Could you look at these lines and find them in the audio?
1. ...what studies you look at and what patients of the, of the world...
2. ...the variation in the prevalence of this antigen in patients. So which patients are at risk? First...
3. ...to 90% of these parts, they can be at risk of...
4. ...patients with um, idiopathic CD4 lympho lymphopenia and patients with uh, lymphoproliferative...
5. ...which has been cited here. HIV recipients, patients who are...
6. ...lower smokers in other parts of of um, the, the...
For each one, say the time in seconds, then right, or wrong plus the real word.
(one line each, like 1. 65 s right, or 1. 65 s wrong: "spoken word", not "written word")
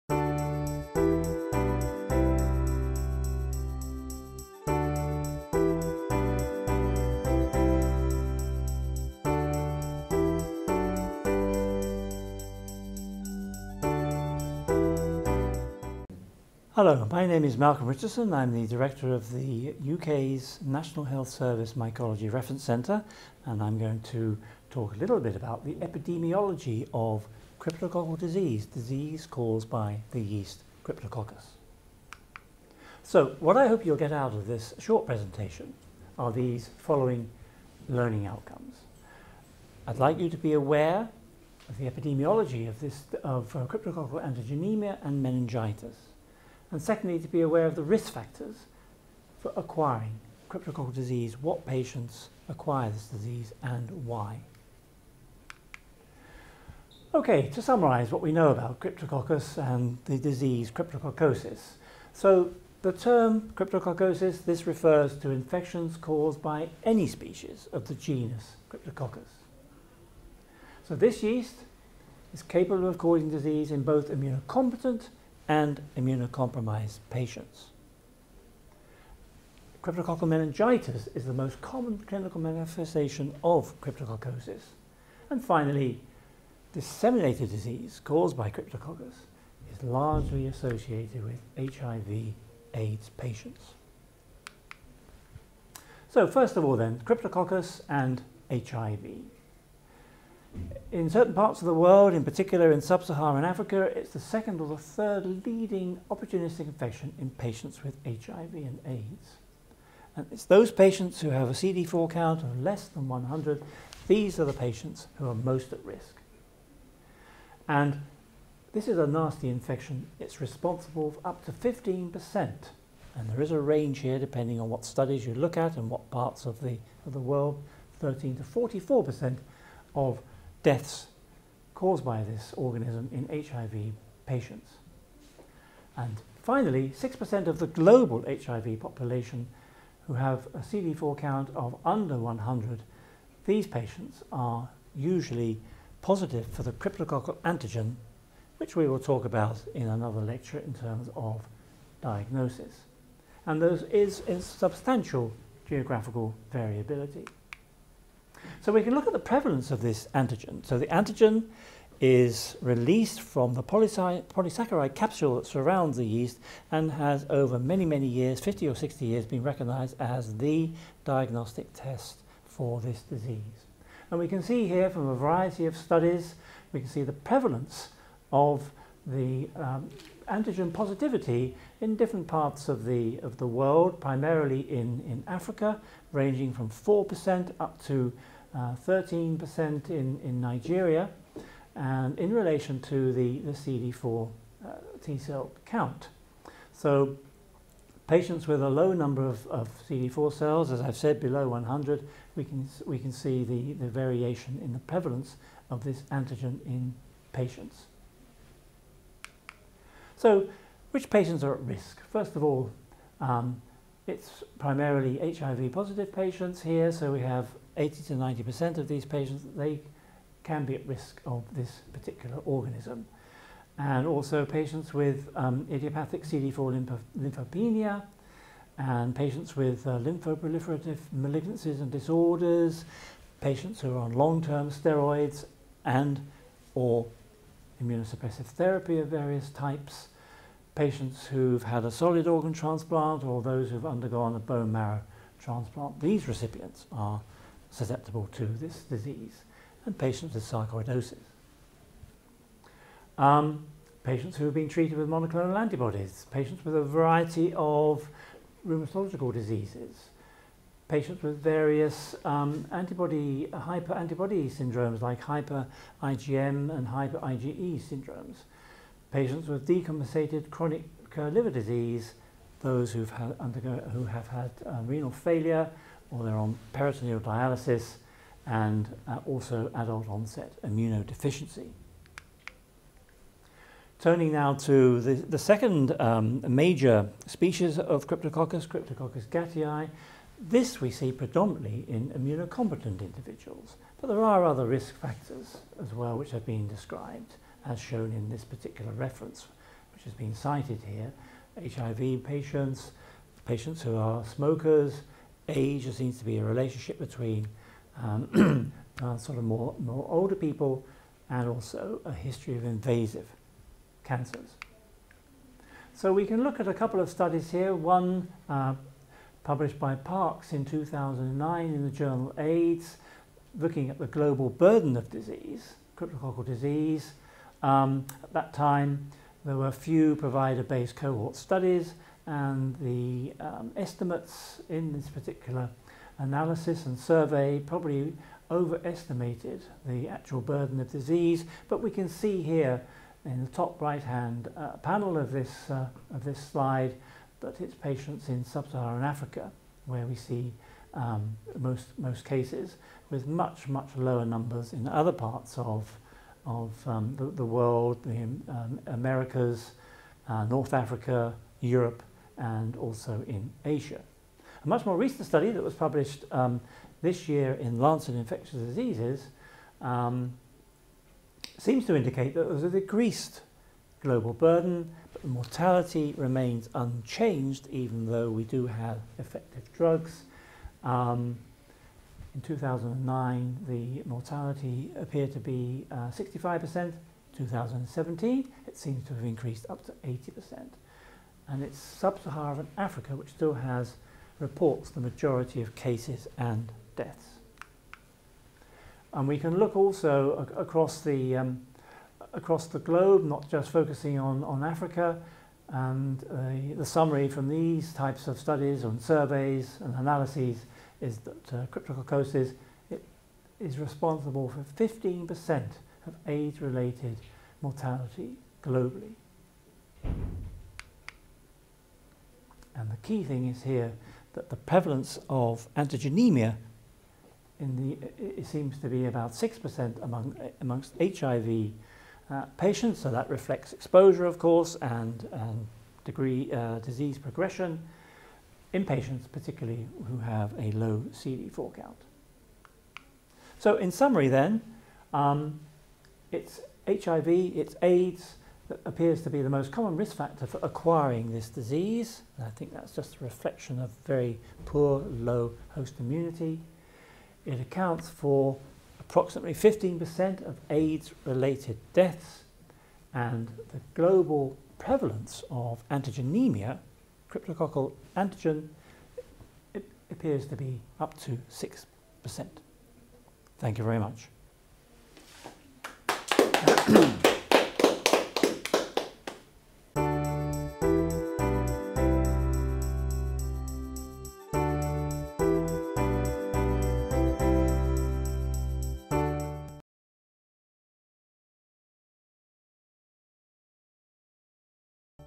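1. 124 s wrong: "parts", not "patients"
2. 203 s right
3. 218 s wrong: "patients", not "parts"
4. 224 s right
5. 299 s wrong: "patients", not "recipients"
6. 353 s wrong: "numbers", not "smokers".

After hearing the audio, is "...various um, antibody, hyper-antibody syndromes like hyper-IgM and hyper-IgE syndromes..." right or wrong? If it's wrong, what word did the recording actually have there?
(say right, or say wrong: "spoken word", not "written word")
right.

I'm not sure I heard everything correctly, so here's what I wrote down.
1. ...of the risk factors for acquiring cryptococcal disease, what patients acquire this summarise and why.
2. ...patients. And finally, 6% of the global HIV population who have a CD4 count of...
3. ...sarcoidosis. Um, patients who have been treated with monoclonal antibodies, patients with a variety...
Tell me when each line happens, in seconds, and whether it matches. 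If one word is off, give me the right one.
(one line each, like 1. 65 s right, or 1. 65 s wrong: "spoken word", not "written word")
1. 47 s wrong: "disease", not "summarise"
2. 134 s right
3. 250 s right.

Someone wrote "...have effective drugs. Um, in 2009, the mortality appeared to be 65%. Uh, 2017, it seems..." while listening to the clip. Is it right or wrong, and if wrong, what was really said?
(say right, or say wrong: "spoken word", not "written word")
right.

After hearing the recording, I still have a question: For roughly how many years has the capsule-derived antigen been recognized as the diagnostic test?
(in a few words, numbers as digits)
50 or 60 years.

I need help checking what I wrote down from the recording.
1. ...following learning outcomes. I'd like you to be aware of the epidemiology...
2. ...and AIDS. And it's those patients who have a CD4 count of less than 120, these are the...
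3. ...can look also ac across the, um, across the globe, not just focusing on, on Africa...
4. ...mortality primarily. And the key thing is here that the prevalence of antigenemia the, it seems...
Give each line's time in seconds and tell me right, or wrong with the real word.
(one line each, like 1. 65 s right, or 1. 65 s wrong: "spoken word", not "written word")
1. 36 s right
2. 108 s wrong: "100", not "120"
3. 399 s right
4. 417 s wrong: "globally", not "primarily".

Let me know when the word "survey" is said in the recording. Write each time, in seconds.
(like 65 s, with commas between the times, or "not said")
336 s, 409 s.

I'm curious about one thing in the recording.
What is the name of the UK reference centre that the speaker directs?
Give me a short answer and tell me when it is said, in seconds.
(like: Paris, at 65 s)
National Health Service Mycology Reference Centre, at 20 s.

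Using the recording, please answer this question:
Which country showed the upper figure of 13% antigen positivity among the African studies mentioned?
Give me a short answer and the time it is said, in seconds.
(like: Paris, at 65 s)
Nigeria, at 190 s.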